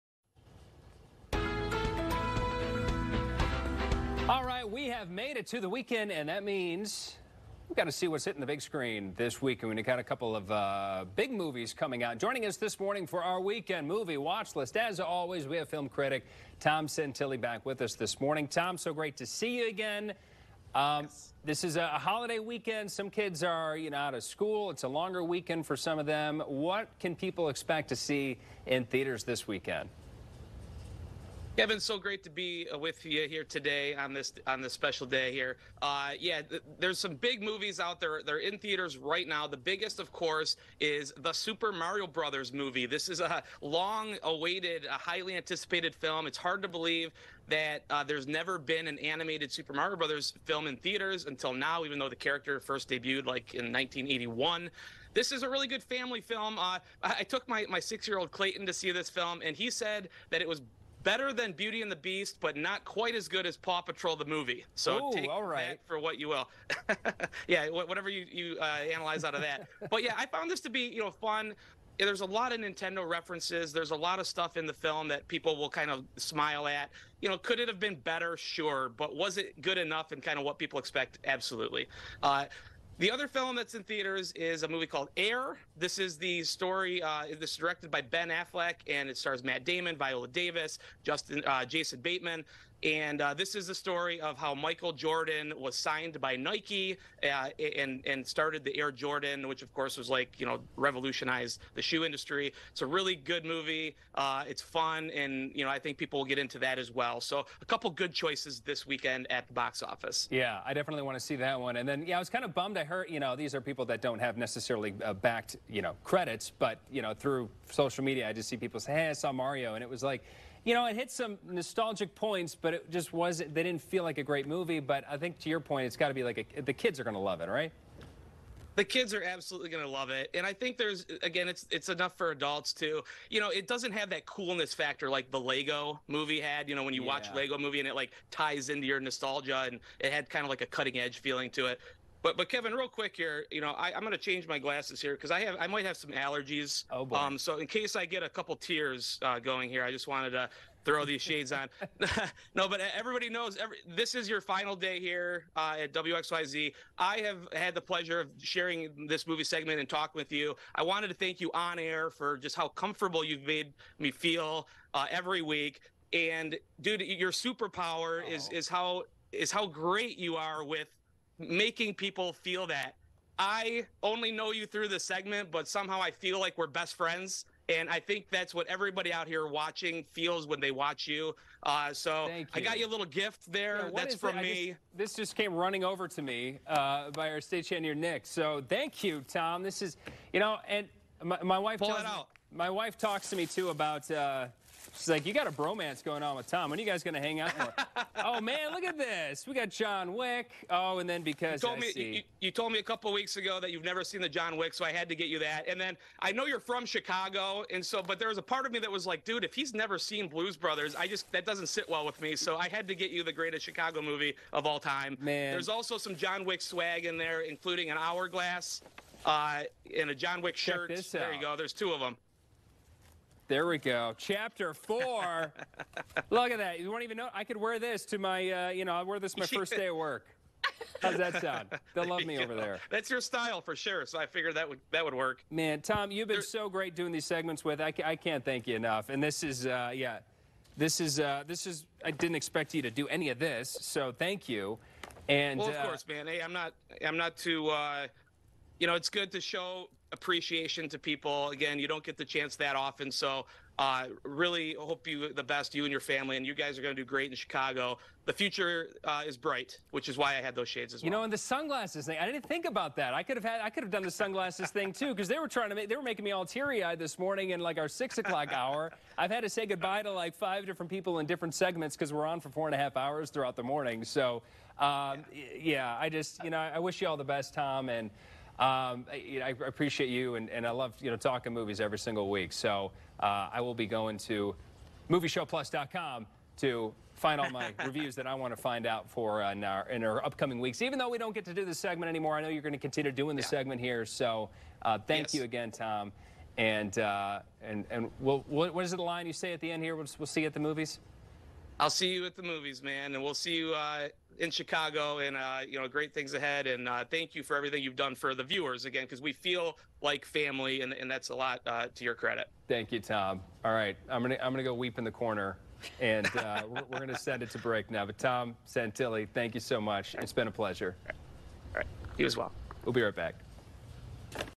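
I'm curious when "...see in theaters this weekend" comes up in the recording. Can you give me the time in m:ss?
0:27.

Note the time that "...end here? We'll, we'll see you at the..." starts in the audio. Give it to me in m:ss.
4:59.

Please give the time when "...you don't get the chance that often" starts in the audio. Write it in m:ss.
4:11.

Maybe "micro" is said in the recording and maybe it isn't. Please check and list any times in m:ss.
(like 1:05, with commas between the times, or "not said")
not said.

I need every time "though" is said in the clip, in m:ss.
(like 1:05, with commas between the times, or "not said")
0:51, 4:50.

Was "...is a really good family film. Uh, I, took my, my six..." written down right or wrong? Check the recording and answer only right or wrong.
right.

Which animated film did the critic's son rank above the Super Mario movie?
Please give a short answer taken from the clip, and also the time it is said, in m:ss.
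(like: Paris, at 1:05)
Paw Patrol the movie, at 1:03.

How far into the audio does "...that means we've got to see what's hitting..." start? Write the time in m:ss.
0:06.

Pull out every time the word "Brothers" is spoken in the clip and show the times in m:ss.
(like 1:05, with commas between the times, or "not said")
0:42, 0:49, 3:30.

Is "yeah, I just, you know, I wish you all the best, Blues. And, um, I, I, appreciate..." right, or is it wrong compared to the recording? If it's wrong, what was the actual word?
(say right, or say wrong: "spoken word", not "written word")
wrong: "Tom", not "Blues".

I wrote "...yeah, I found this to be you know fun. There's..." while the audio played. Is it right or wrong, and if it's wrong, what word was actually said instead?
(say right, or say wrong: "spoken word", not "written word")
right.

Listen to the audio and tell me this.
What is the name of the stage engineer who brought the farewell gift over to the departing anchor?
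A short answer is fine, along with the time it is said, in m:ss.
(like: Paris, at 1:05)
Nick, at 3:07.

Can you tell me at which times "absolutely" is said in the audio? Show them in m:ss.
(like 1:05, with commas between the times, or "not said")
1:21, 2:09.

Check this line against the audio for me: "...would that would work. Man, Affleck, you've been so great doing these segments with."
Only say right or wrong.
wrong.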